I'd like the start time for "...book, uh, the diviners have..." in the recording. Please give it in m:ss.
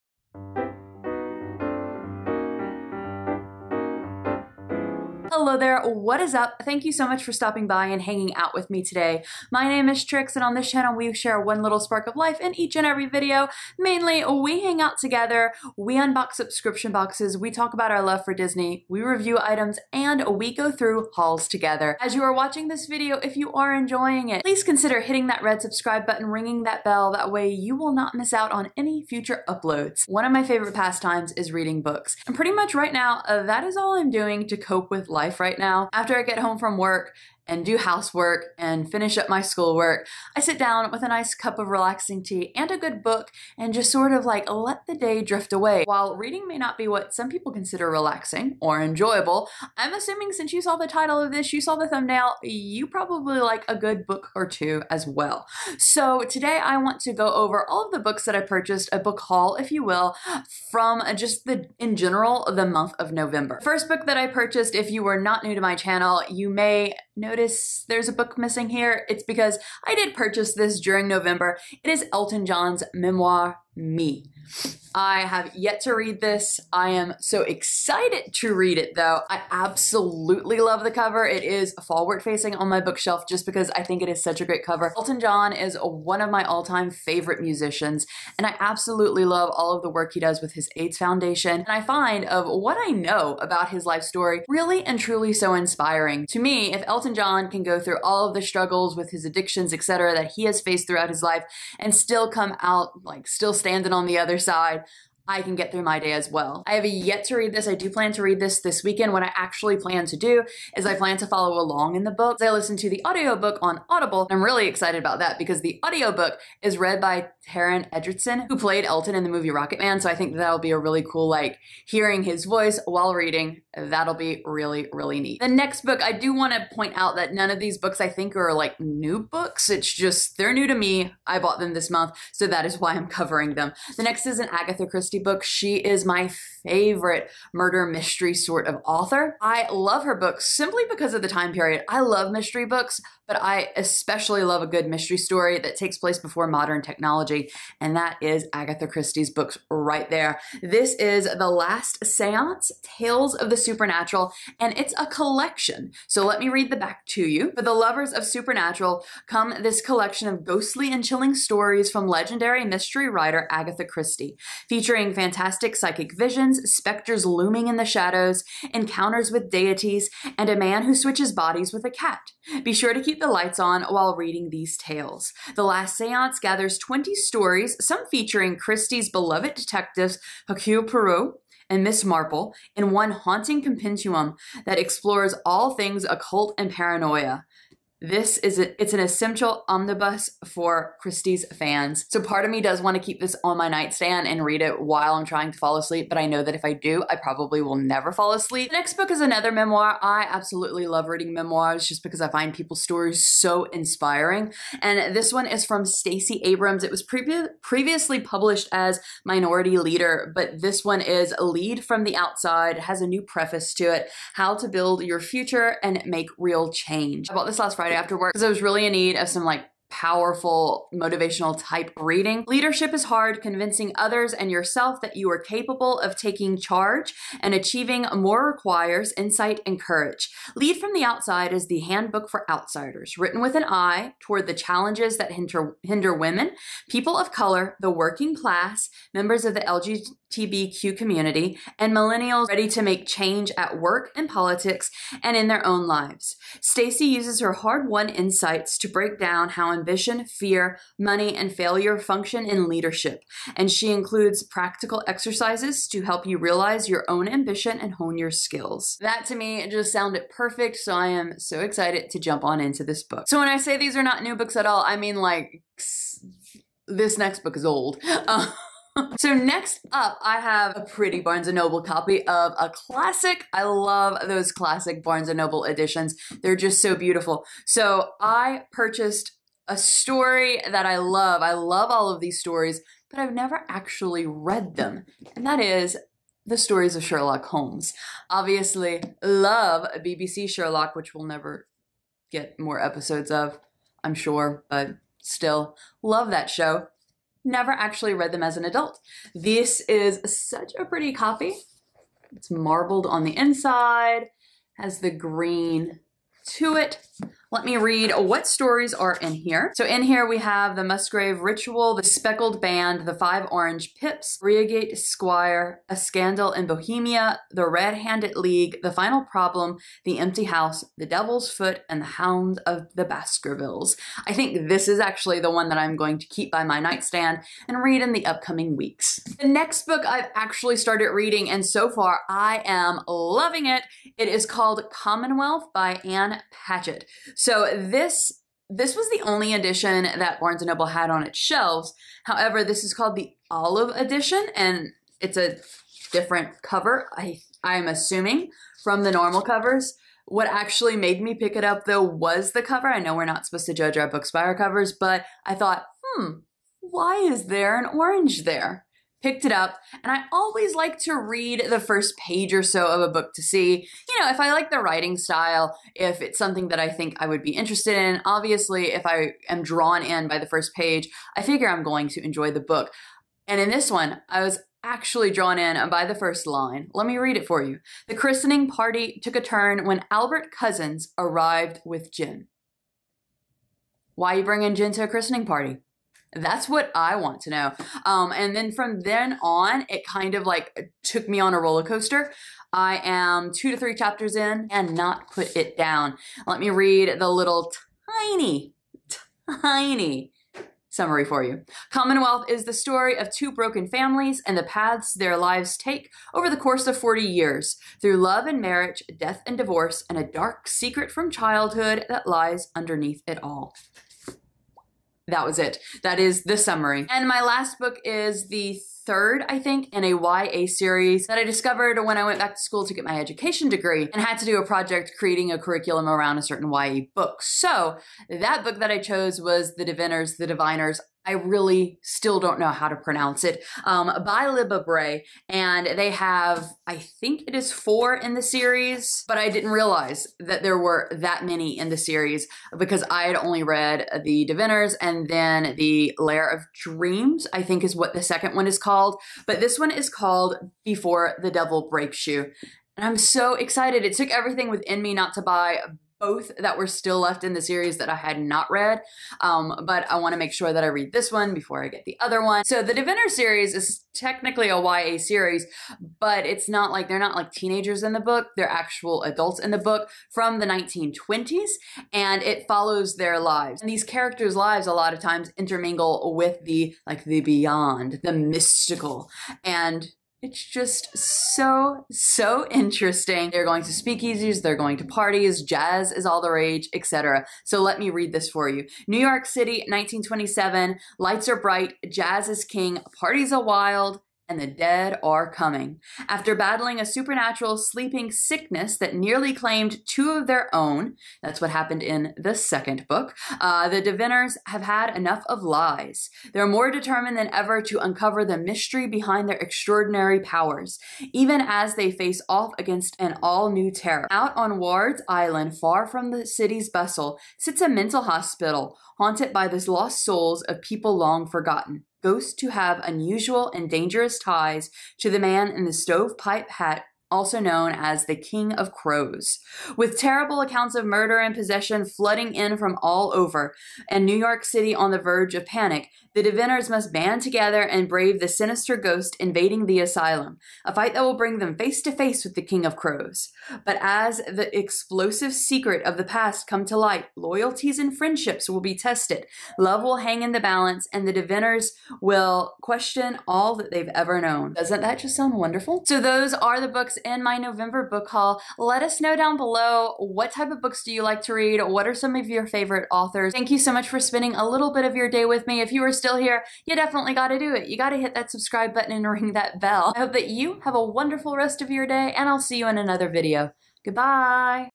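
8:23.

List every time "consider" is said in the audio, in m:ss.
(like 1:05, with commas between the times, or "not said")
0:24, 0:47.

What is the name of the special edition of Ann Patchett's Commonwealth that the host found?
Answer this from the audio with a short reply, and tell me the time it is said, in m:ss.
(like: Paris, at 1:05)
Olive Edition, at 5:43.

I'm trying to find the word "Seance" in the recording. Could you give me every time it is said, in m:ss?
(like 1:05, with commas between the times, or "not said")
2:32, 2:55.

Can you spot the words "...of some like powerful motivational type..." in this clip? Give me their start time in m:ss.
3:39.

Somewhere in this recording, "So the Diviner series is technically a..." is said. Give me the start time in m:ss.
7:42.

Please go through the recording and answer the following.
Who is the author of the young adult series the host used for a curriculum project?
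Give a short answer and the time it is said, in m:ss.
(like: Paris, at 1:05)
Libba Bray, at 7:14.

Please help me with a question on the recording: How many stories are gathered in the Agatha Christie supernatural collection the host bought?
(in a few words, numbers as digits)
20.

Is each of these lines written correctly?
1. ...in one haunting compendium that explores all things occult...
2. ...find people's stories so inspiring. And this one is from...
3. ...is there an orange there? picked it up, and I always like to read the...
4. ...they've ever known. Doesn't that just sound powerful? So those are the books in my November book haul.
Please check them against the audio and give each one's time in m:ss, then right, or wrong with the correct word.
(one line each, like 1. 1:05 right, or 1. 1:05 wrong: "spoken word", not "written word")
1. 3:02 right
2. 3:22 right
3. 5:57 right
4. 9:13 wrong: "wonderful", not "powerful".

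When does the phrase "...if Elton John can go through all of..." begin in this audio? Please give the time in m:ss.
1:36.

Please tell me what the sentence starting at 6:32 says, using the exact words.
I am two to three chapters in and not put it down.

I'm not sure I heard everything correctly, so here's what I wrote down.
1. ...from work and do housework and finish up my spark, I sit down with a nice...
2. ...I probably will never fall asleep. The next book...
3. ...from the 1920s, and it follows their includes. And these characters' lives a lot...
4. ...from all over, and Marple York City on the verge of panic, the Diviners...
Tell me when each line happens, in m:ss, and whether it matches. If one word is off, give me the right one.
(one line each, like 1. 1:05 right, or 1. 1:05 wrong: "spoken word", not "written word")
1. 0:36 wrong: "schoolwork", not "spark"
2. 3:17 right
3. 7:50 wrong: "lives", not "includes"
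4. 8:52 wrong: "New", not "Marple".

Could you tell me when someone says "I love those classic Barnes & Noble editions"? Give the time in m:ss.
4:33.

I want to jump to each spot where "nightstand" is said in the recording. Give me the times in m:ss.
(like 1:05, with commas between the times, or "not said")
3:13, 5:26.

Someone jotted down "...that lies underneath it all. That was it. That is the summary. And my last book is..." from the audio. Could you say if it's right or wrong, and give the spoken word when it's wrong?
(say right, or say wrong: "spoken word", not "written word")
right.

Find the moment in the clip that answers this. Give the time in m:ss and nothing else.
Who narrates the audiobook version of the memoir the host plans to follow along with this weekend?
1:57.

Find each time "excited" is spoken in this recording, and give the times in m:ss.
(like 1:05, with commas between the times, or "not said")
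1:17, 1:54, 4:21, 7:33.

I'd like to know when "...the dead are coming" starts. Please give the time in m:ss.
8:14.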